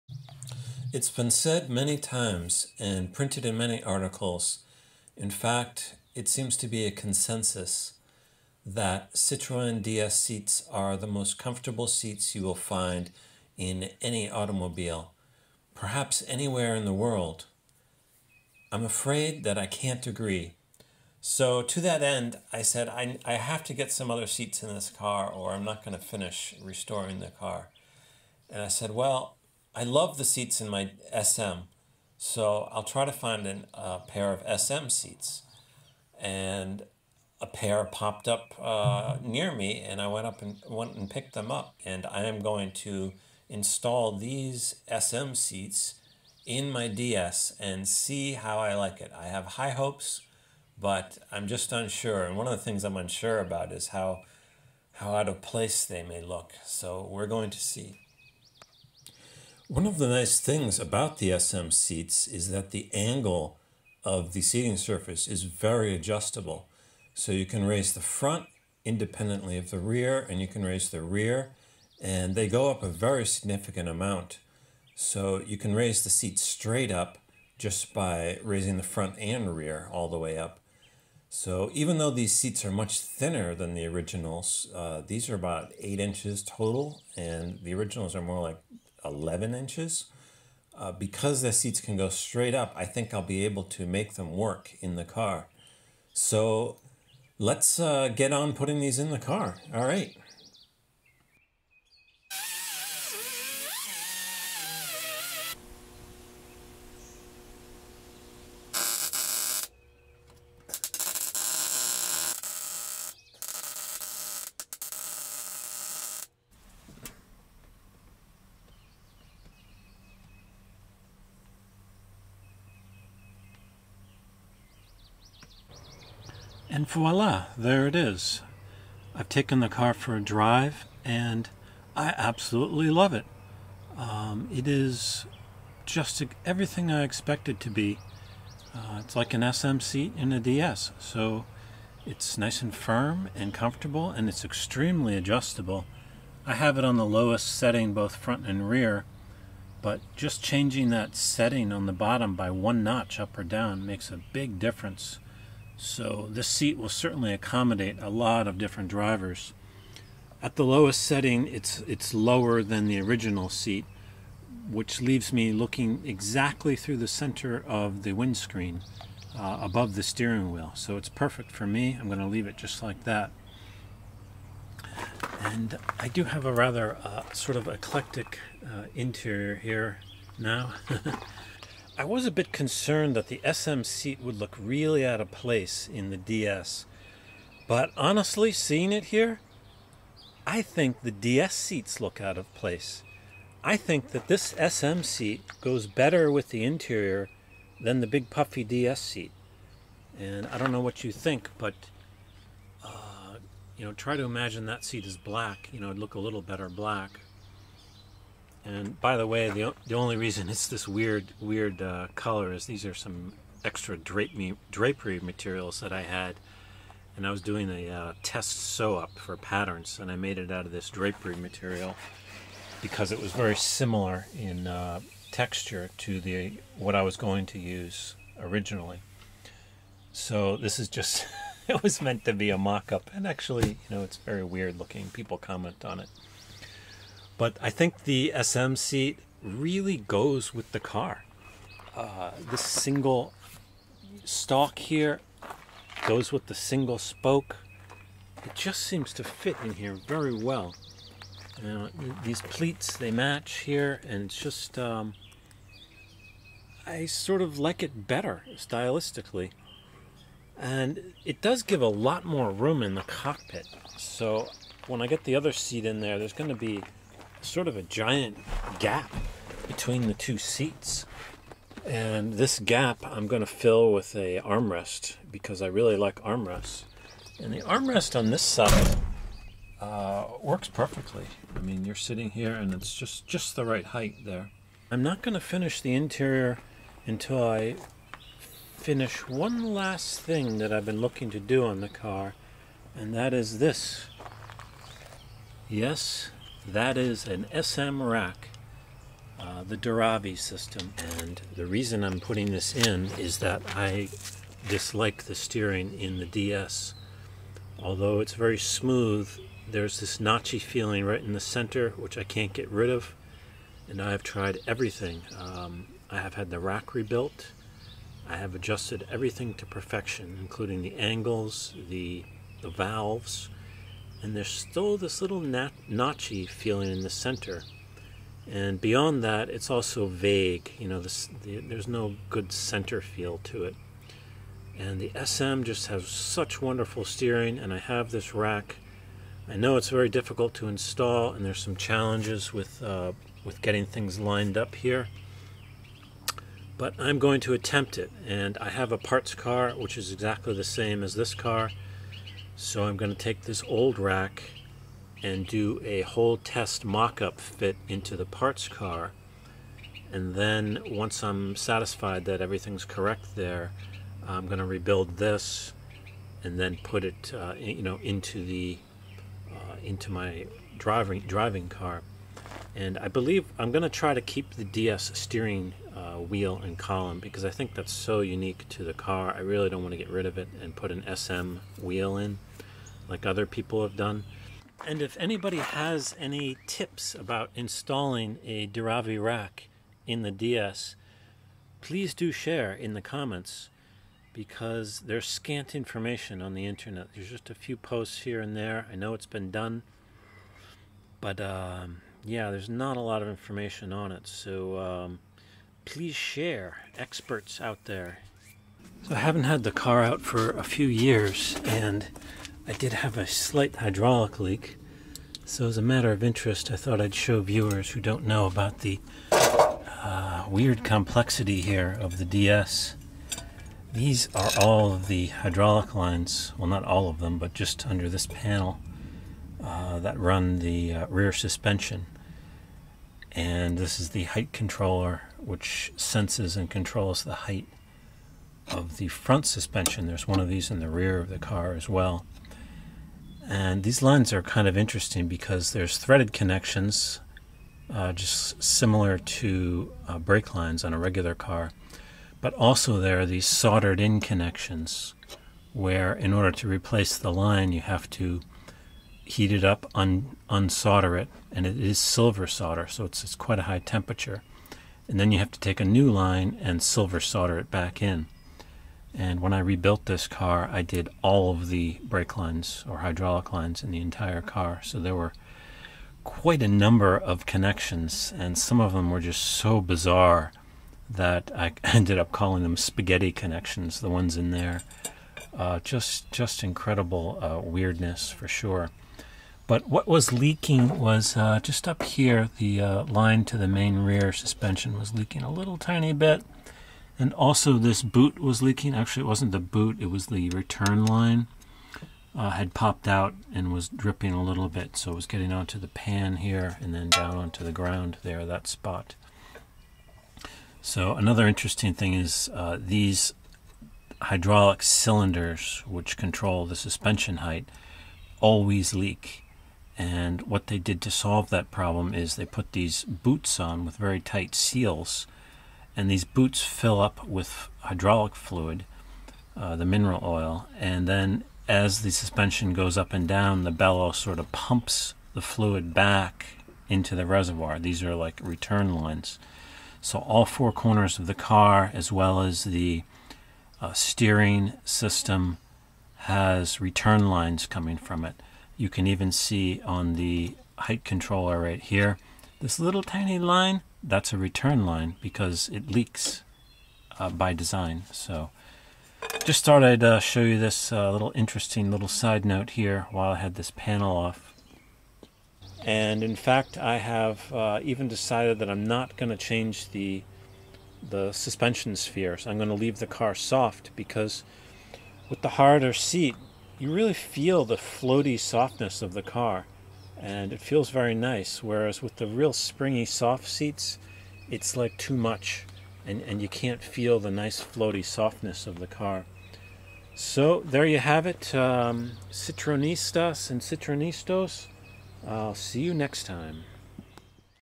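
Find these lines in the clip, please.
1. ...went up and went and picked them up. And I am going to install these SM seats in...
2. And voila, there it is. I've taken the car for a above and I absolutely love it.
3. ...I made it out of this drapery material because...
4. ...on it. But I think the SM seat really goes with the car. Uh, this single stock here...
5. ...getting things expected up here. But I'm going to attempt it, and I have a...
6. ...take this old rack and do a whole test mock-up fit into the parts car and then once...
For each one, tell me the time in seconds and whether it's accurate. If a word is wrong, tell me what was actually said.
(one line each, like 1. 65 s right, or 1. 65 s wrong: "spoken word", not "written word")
1. 40 s right
2. 126 s wrong: "drive", not "above"
3. 220 s right
4. 235 s right
5. 343 s wrong: "lined", not "expected"
6. 353 s right.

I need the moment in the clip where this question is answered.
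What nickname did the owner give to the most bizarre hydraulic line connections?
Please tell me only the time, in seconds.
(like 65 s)
482 s.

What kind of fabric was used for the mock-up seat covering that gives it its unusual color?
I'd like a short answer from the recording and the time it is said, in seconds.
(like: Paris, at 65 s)
drapery material, at 214 s.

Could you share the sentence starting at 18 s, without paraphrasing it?
I'm afraid that I can't agree.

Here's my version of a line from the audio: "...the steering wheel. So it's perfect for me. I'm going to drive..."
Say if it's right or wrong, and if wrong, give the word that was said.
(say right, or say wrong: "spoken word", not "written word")
wrong: "leave", not "drive".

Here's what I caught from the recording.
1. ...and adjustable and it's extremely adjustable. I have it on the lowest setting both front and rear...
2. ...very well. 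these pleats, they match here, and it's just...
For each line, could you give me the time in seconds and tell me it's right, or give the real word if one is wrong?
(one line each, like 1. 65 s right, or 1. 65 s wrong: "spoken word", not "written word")
1. 143 s wrong: "comfortable", not "adjustable"
2. 250 s right.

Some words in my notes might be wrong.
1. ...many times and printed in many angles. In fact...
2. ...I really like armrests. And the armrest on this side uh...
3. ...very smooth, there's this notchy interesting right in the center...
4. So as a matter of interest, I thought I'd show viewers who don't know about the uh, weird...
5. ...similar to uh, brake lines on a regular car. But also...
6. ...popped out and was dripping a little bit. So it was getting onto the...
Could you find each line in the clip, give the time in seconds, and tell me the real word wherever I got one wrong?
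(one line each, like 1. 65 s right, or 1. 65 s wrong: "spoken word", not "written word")
1. 1 s wrong: "articles", not "angles"
2. 275 s right
3. 308 s wrong: "feeling", not "interesting"
4. 415 s right
5. 448 s right
6. 502 s right.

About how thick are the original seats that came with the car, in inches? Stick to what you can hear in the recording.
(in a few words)
11 inches.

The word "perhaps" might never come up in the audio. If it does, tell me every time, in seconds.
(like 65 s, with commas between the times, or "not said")
15 s.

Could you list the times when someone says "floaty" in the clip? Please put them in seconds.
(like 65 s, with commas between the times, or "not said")
577 s, 587 s.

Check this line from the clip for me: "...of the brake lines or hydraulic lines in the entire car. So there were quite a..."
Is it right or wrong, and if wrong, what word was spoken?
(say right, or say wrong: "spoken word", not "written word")
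right.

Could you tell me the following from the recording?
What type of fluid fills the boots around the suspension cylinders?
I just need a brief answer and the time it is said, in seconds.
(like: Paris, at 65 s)
mineral oil, at 529 s.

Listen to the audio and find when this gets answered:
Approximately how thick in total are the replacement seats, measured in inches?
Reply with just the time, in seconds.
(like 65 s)
85 s.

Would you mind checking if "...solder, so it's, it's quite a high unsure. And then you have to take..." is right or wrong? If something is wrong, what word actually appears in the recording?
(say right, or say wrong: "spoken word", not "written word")
wrong: "temperature", not "unsure".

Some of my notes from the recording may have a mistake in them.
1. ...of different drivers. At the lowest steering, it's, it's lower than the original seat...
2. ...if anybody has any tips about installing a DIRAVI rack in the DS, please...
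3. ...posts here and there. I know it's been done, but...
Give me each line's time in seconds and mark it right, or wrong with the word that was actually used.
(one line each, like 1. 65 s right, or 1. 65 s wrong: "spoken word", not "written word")
1. 158 s wrong: "setting", not "steering"
2. 385 s right
3. 397 s right.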